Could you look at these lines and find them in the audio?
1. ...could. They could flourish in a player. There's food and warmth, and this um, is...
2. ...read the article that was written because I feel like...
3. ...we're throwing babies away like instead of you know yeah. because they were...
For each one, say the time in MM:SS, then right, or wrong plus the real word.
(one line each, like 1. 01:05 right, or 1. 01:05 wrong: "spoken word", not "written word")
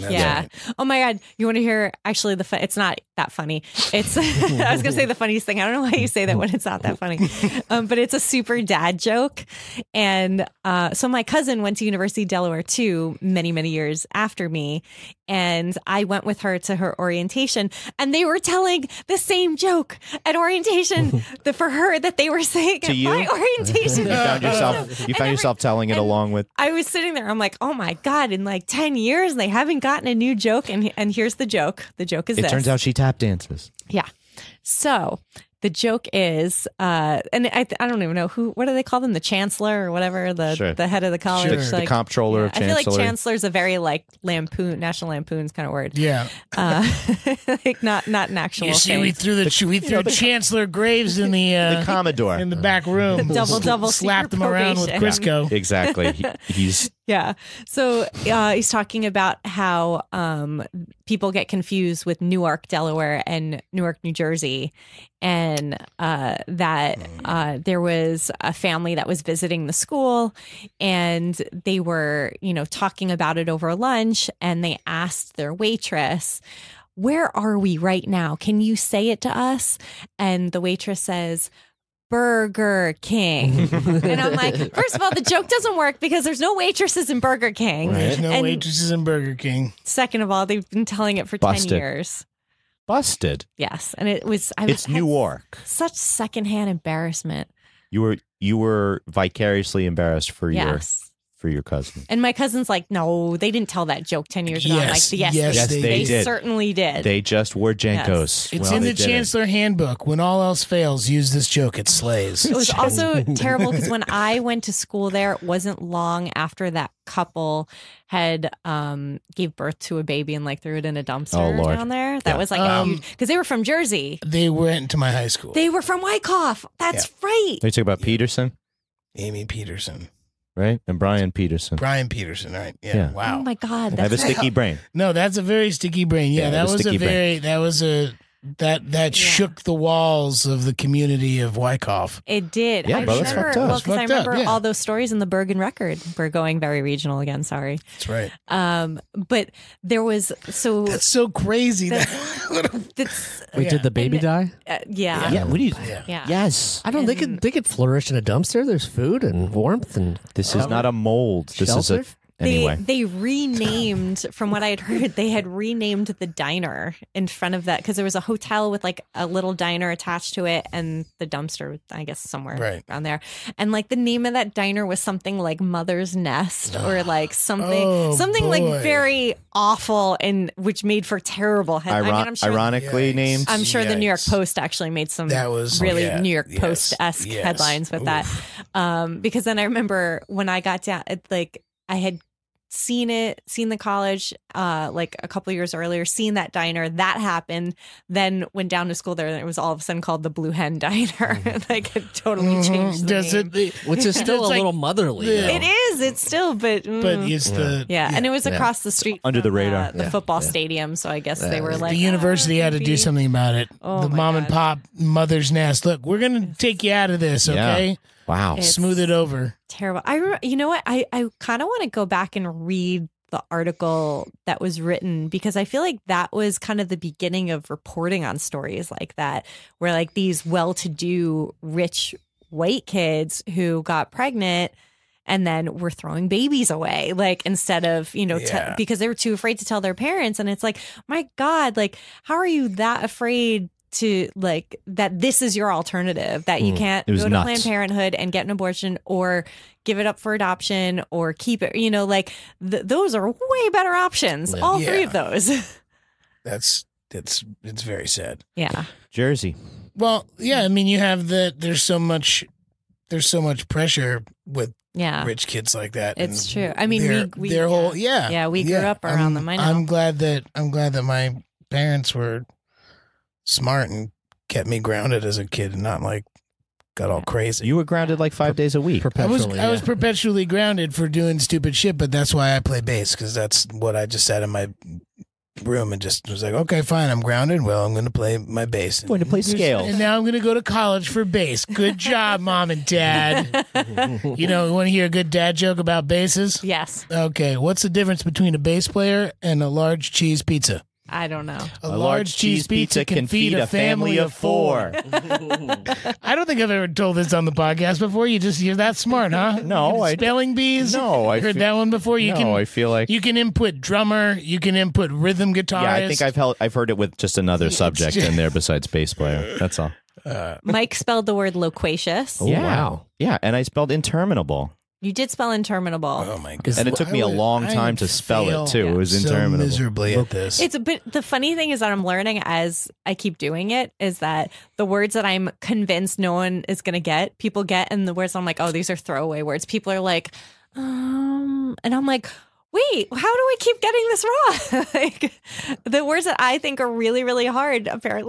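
1. 02:37 wrong: "dumpster", not "player"
2. 03:42 right
3. 03:55 right.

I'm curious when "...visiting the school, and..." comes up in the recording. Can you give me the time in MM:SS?
01:09.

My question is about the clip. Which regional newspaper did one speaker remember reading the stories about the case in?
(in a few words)
Bergen Record.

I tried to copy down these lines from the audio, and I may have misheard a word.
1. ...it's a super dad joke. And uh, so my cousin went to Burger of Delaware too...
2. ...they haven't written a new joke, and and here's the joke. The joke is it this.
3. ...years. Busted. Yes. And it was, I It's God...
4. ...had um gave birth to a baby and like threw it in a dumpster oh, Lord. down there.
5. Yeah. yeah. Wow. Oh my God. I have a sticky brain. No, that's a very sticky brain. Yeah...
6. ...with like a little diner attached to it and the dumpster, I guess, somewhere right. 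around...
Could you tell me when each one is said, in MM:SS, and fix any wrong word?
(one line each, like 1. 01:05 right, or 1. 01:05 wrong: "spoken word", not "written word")
1. 00:07 wrong: "University", not "Burger"
2. 00:29 wrong: "gotten", not "written"
3. 01:31 wrong: "New", not "God"
4. 01:58 right
5. 02:12 right
6. 02:48 right.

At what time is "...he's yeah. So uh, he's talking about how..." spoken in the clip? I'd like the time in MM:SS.
00:56.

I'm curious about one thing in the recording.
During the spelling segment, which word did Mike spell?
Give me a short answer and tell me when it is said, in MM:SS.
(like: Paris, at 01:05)
loquacious, at 05:21.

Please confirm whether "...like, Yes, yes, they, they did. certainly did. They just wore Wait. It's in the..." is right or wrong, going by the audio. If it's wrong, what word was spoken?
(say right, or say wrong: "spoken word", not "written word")
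wrong: "Jankos", not "Wait".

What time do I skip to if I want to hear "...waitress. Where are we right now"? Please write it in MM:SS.
01:15.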